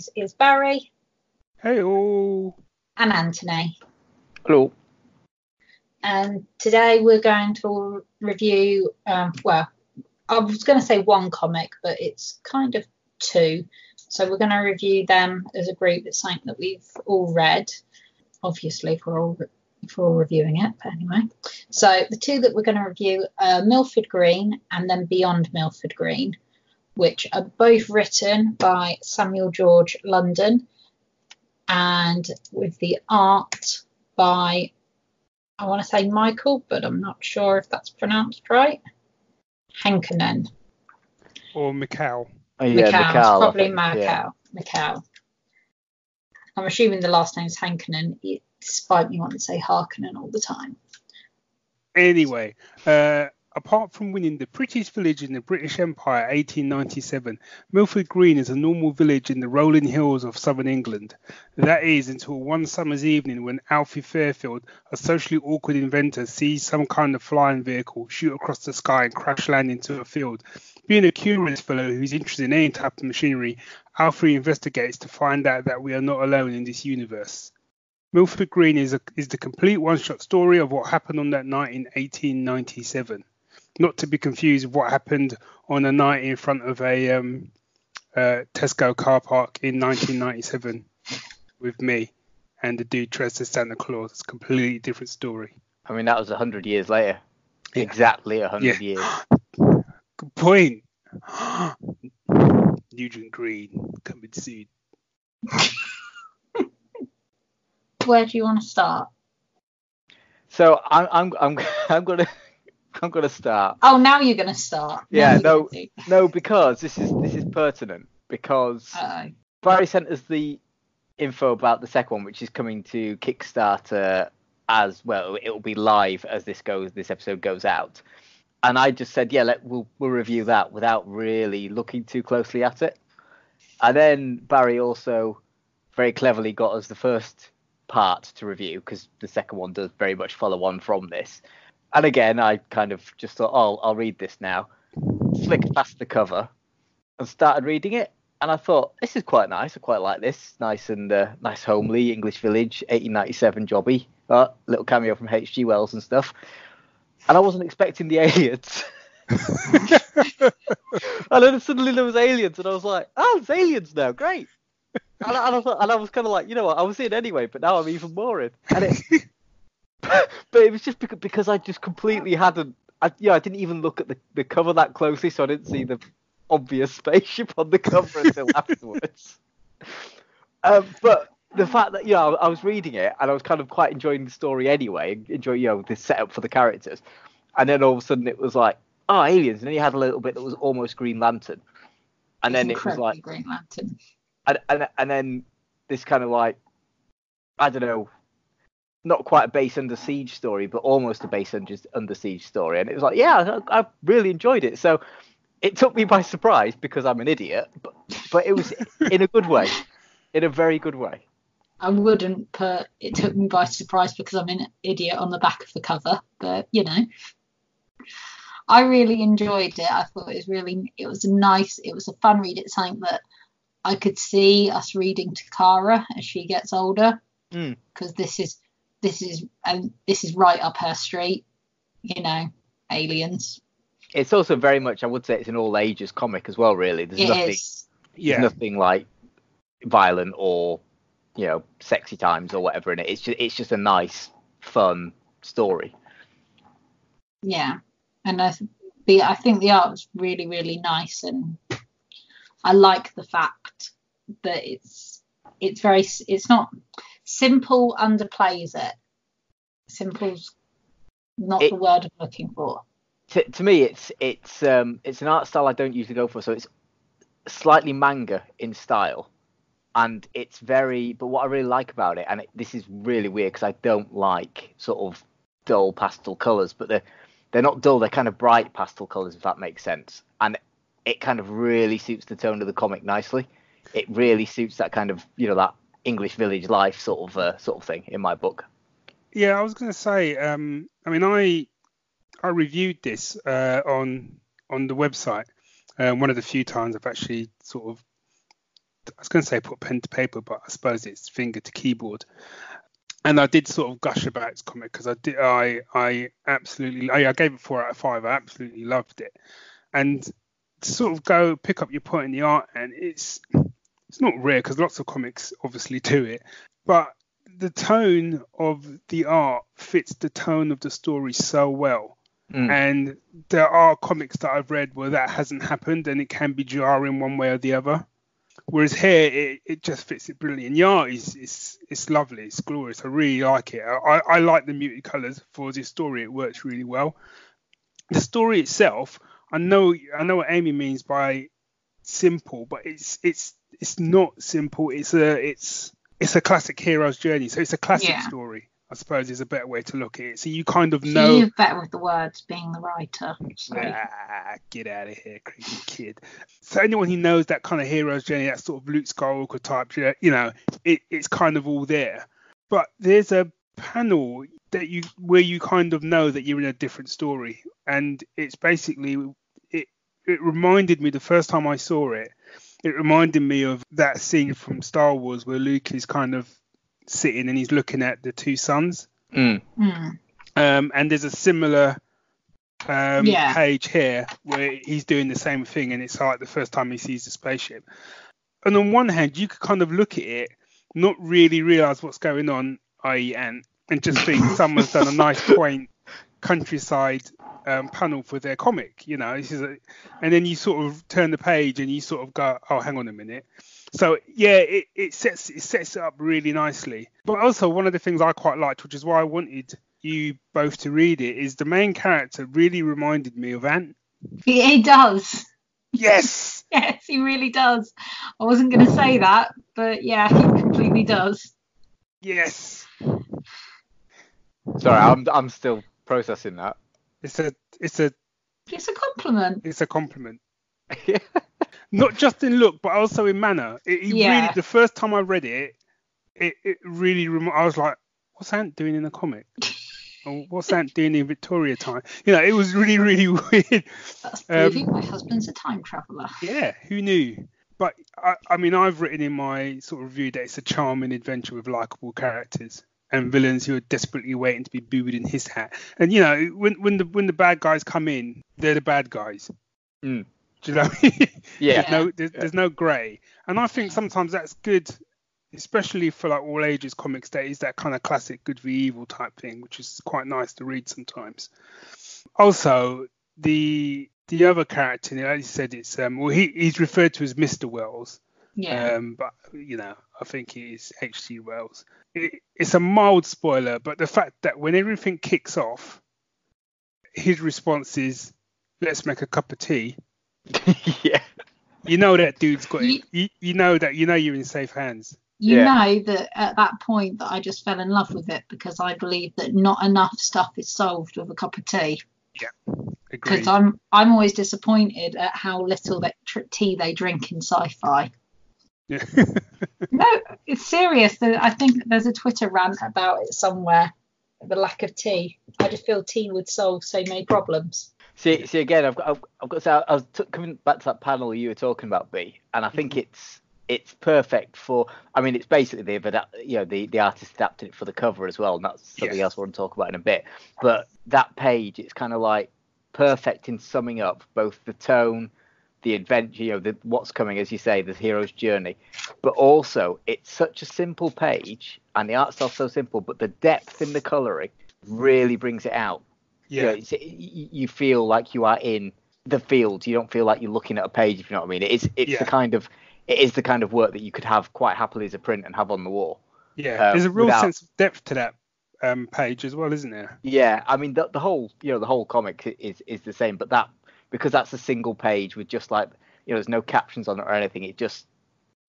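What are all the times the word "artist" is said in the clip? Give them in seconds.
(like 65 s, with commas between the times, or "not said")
526 s.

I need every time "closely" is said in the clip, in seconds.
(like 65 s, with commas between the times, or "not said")
132 s, 174 s.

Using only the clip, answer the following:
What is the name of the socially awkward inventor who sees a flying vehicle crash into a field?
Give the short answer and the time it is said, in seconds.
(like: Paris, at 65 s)
Alfie Fairfield, at 63 s.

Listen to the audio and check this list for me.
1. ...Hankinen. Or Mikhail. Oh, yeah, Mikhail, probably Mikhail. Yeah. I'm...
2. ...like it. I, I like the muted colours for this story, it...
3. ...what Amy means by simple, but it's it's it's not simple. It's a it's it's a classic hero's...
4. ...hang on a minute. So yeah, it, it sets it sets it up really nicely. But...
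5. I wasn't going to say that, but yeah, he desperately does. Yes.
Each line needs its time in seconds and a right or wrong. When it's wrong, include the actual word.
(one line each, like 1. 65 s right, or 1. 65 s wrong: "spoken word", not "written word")
1. 39 s right
2. 333 s right
3. 340 s right
4. 402 s right
5. 418 s wrong: "completely", not "desperately".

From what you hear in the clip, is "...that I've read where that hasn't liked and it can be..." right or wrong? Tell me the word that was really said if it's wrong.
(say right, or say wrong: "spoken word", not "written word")
wrong: "happened", not "liked".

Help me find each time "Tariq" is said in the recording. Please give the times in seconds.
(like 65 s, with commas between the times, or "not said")
not said.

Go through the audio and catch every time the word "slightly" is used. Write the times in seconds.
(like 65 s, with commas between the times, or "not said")
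267 s.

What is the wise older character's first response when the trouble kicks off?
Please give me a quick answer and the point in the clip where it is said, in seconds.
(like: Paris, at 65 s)
make a cup of tea, at 489 s.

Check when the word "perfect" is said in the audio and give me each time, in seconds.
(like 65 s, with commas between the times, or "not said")
523 s, 532 s.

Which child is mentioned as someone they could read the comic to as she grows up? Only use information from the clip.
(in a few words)
Kara.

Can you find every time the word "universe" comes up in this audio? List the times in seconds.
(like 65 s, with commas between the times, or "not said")
76 s.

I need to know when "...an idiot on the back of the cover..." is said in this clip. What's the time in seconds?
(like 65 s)
214 s.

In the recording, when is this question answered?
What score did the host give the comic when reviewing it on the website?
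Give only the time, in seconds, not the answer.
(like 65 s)
307 s.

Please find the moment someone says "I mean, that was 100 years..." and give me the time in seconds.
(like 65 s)
95 s.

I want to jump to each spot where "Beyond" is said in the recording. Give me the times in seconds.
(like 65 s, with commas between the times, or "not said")
25 s.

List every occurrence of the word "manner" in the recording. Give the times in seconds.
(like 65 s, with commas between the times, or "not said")
433 s.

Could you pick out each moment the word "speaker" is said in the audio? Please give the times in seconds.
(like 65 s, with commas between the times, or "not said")
not said.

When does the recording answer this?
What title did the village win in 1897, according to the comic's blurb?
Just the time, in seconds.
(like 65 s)
54 s.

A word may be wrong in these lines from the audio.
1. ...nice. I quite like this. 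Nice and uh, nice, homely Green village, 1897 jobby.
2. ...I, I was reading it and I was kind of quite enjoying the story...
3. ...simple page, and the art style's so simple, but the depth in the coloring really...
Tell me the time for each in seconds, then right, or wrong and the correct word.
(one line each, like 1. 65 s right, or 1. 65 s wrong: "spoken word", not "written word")
1. 149 s wrong: "English", not "Green"
2. 182 s right
3. 540 s right.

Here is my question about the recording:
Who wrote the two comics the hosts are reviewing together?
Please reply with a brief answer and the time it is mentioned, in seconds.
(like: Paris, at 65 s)
Samuel George London, at 29 s.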